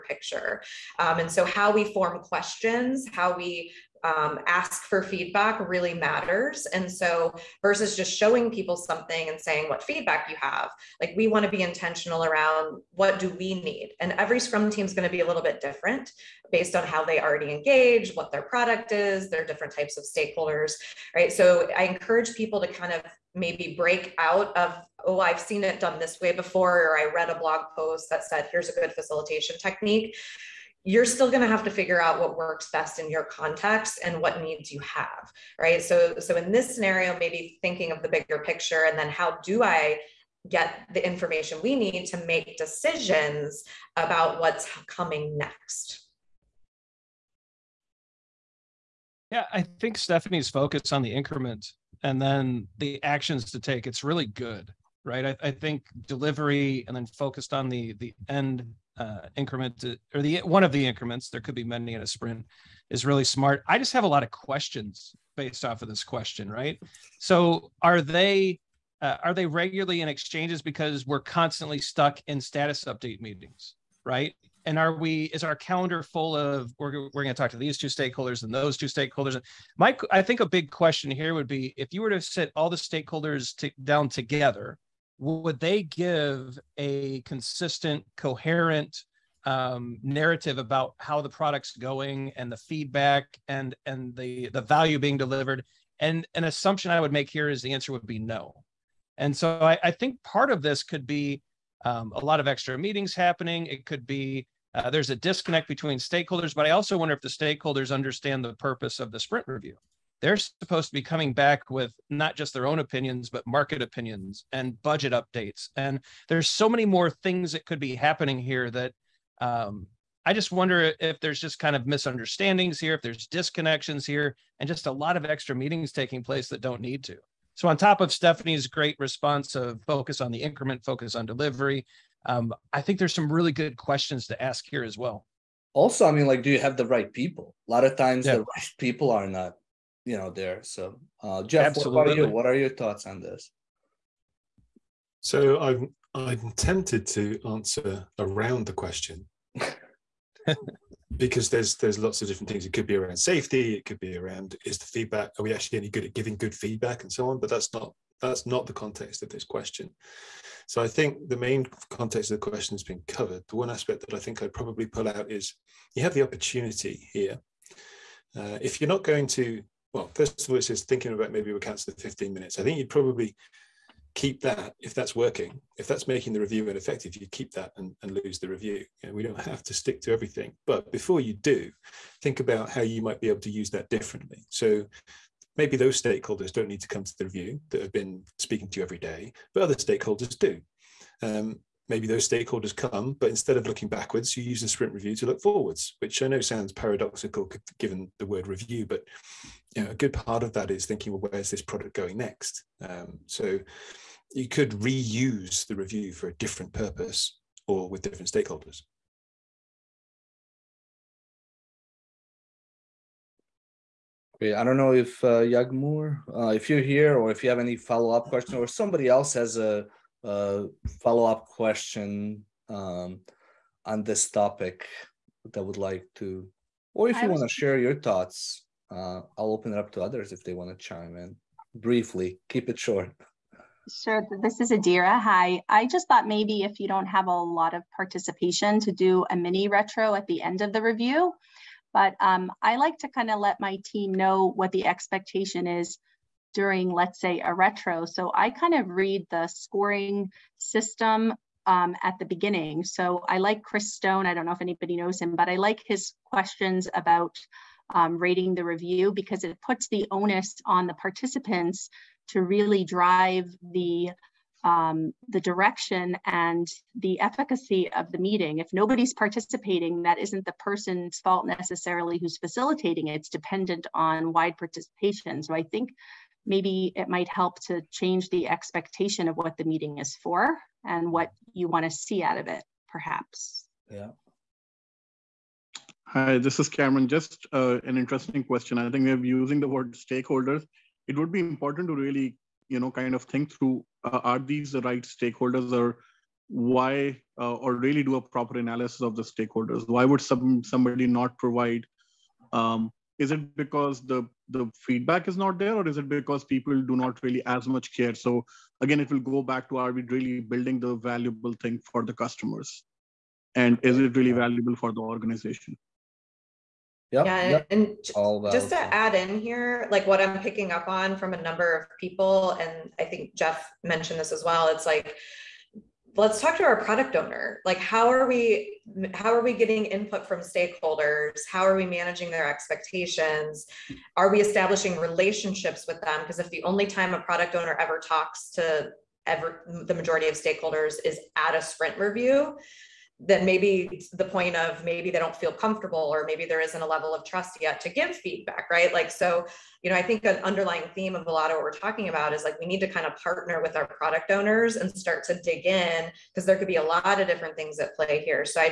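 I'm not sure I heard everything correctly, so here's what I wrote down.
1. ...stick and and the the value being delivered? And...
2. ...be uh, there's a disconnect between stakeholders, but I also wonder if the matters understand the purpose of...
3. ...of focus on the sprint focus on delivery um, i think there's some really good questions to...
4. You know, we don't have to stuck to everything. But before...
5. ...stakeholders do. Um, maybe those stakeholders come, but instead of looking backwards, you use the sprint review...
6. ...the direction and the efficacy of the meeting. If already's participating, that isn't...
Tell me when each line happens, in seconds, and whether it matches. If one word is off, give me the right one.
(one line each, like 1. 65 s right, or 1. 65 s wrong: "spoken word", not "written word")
1. 92 s wrong: "feedback", not "stick"
2. 104 s wrong: "stakeholders", not "matters"
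3. 129 s wrong: "increment", not "sprint"
4. 179 s wrong: "stick", not "stuck"
5. 189 s right
6. 265 s wrong: "nobody", not "already".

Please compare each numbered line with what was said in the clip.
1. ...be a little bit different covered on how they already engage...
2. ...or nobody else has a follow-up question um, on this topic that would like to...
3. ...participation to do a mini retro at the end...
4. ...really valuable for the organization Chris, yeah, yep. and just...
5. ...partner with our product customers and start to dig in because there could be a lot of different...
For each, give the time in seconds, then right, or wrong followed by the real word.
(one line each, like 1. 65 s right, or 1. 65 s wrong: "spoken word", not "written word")
1. 15 s wrong: "based", not "covered"
2. 218 s wrong: "somebody", not "nobody"
3. 237 s right
4. 314 s wrong: "Yep", not "Chris"
5. 353 s wrong: "owners", not "customers".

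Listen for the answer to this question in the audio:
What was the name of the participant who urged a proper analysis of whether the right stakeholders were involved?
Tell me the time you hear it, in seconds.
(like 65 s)
286 s.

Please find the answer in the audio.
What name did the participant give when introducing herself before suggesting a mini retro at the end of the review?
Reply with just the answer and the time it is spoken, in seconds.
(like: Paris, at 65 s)
Adira, at 234 s.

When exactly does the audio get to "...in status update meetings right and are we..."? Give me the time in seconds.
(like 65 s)
72 s.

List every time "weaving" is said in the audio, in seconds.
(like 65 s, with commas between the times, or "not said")
not said.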